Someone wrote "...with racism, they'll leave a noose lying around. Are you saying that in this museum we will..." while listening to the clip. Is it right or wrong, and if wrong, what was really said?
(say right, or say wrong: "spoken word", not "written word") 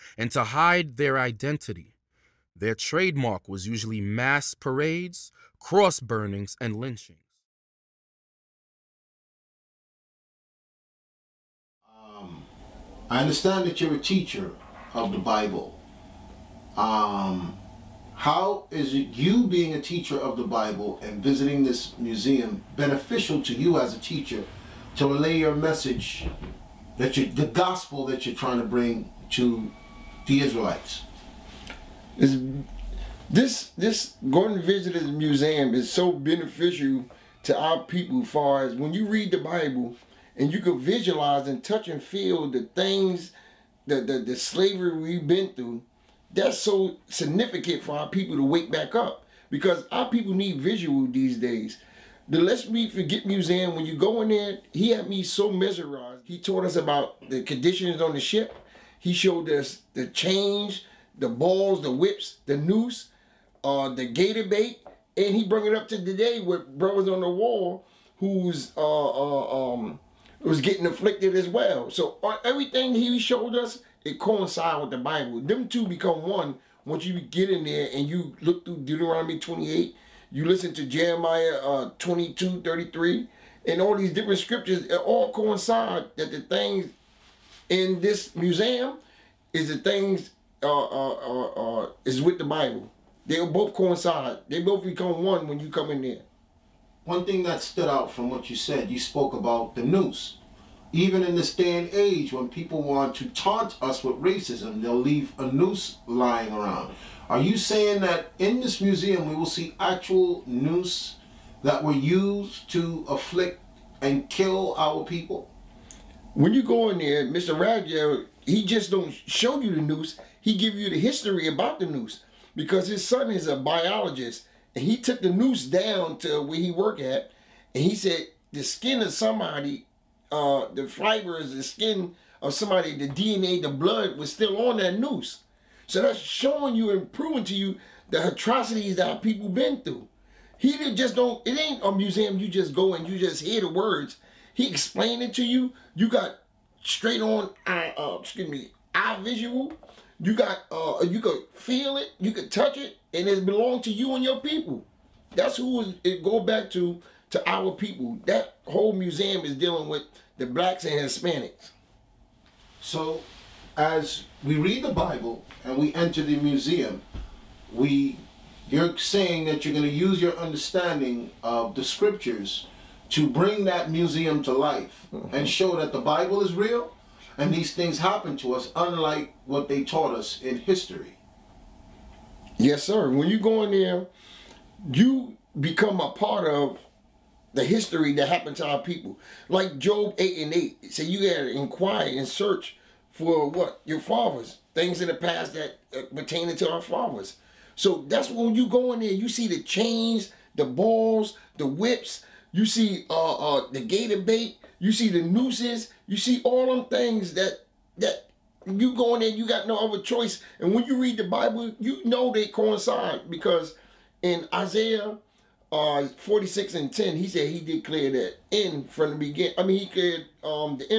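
right.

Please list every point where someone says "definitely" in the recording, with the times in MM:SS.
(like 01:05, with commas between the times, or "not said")
not said.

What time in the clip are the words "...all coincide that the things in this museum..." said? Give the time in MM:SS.
01:24.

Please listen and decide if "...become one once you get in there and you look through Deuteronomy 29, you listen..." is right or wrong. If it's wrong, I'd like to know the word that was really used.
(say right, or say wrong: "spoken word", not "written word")
wrong: "28", not "29".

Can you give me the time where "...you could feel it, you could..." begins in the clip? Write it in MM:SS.
02:31.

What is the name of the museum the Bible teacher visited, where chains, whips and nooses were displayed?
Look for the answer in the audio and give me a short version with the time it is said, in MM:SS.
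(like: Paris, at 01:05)
Lest We Forget Museum, at 00:52.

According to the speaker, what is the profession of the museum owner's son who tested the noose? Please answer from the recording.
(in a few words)
Biologist.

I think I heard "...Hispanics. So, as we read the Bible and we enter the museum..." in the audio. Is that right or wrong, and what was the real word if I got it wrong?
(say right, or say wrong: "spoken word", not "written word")
right.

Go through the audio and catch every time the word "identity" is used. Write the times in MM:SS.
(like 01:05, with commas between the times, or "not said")
00:01.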